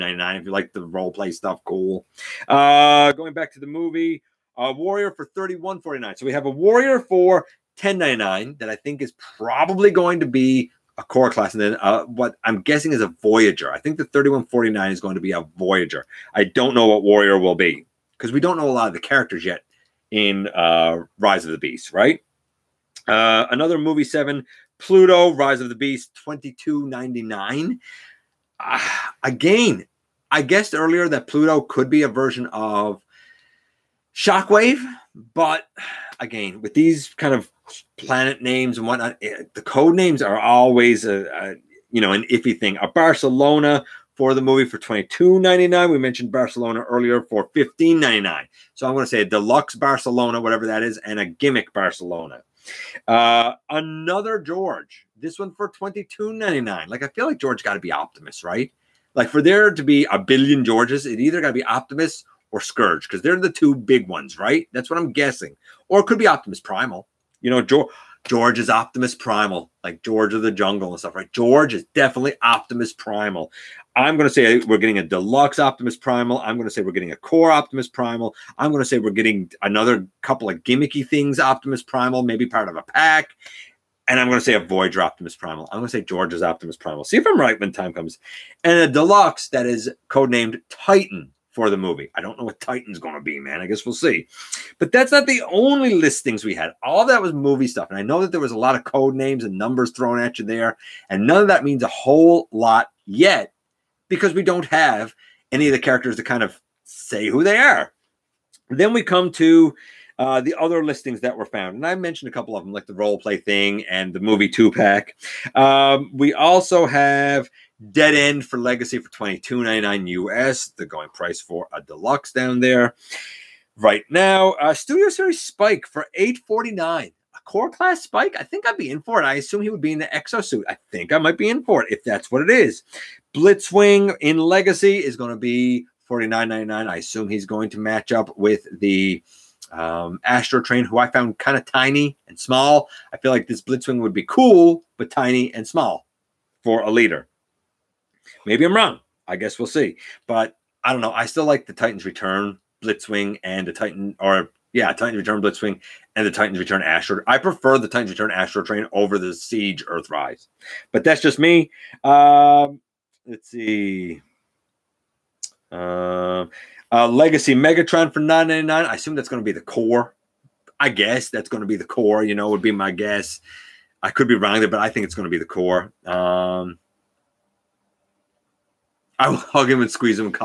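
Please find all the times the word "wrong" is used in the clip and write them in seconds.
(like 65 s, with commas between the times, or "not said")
148 s, 174 s.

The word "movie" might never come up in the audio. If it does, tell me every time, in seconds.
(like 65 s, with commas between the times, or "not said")
3 s, 23 s, 44 s, 91 s, 97 s, 114 s.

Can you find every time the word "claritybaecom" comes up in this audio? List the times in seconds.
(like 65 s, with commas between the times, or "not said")
not said.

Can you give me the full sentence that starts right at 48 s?
So I'm going to say deluxe Barcelona, whatever that is, and a gimmick Barcelona.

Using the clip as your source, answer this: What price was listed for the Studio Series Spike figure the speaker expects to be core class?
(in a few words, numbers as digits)
$8.49.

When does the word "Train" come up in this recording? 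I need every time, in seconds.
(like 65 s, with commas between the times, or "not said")
140 s, 158 s.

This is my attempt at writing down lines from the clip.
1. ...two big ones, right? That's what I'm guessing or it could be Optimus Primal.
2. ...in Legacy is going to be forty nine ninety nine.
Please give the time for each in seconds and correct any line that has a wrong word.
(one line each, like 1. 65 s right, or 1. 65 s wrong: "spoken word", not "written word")
1. 63 s right
2. 134 s right.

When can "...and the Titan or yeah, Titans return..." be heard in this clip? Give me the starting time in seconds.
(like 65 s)
153 s.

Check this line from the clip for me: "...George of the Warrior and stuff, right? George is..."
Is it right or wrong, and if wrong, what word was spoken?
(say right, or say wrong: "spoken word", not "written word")
wrong: "Jungle", not "Warrior".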